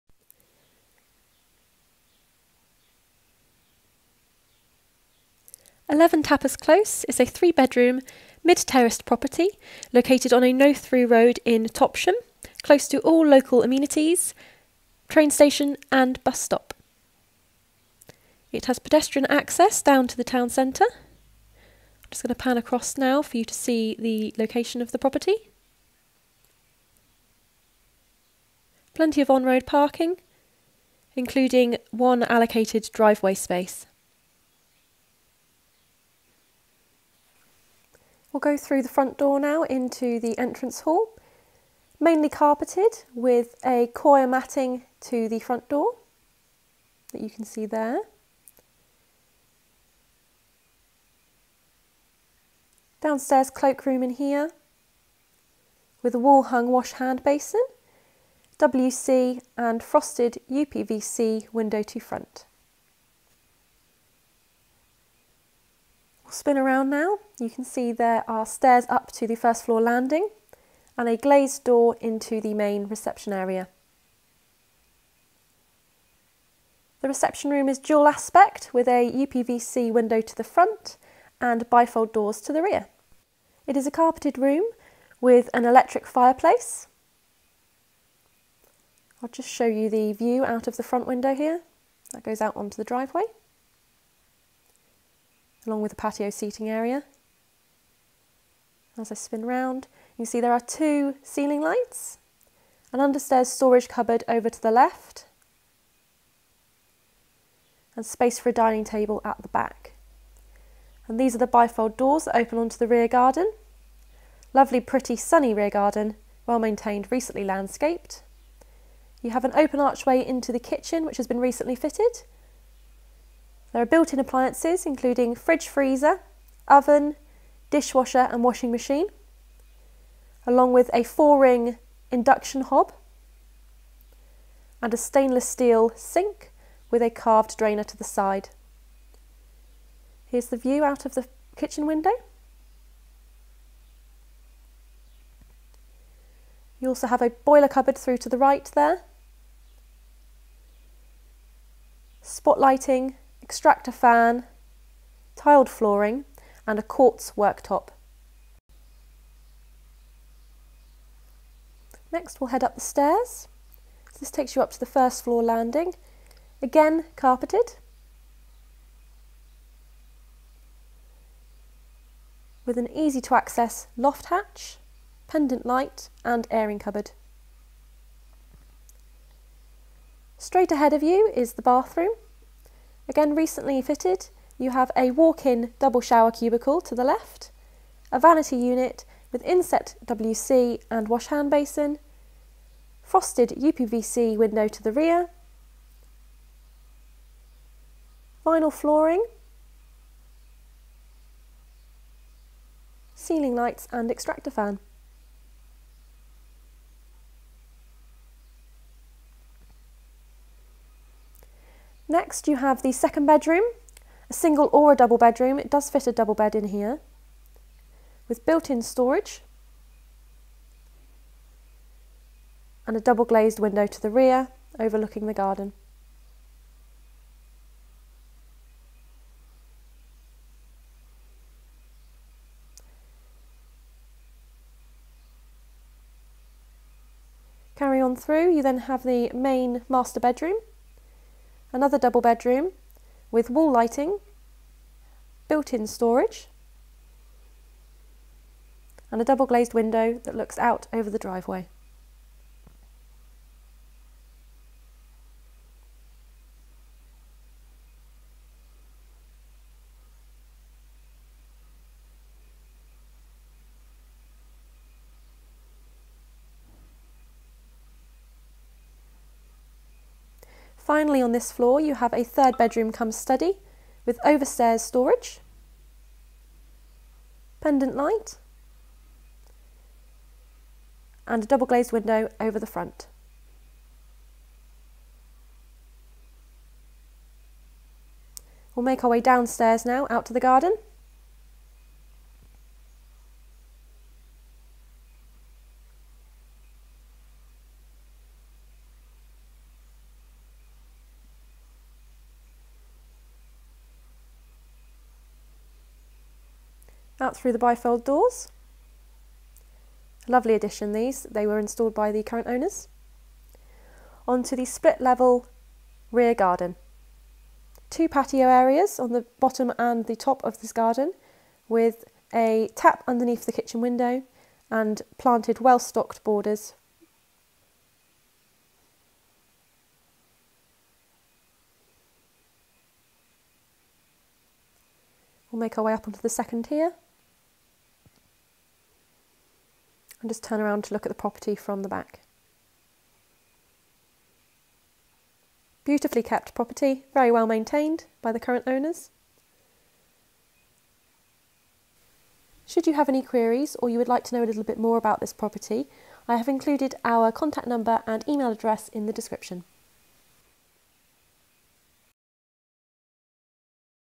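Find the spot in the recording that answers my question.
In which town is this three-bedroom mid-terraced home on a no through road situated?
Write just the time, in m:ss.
0:11.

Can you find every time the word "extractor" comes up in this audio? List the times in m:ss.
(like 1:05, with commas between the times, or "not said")
2:33, 3:24.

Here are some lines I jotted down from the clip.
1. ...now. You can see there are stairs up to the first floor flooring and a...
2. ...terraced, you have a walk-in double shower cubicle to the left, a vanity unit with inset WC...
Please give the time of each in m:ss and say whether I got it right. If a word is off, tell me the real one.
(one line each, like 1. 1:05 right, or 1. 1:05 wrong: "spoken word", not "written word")
1. 1:06 wrong: "landing", not "flooring"
2. 3:03 wrong: "fitted", not "terraced".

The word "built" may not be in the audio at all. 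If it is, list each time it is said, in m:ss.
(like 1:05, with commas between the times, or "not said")
2:03, 3:38, 4:05.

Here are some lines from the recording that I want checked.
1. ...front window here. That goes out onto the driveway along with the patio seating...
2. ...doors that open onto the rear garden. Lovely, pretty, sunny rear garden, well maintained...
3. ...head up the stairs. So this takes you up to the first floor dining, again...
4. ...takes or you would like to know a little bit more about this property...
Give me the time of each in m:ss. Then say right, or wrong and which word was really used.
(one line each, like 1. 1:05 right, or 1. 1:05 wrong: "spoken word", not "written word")
1. 1:30 right
2. 1:51 right
3. 2:42 wrong: "landing", not "dining"
4. 5:53 wrong: "queries", not "takes".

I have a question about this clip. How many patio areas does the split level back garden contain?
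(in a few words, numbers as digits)
2.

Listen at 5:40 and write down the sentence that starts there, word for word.
and just turn around to look at the property from the back.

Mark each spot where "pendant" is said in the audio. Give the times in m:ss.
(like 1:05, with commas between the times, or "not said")
2:55, 4:37.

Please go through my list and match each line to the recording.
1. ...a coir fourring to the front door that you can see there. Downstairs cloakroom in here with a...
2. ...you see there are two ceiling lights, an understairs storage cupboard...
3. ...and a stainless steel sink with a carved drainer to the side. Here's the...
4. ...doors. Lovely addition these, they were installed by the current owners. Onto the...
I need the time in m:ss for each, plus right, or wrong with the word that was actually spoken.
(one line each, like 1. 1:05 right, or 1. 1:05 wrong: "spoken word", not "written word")
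1. 0:43 wrong: "matting", not "fourring"
2. 1:40 right
3. 2:14 right
4. 5:08 right.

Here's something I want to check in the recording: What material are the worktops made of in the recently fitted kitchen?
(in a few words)
quartz.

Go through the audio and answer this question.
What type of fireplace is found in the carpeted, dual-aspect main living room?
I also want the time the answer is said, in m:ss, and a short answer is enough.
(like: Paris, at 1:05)
electric, at 1:25.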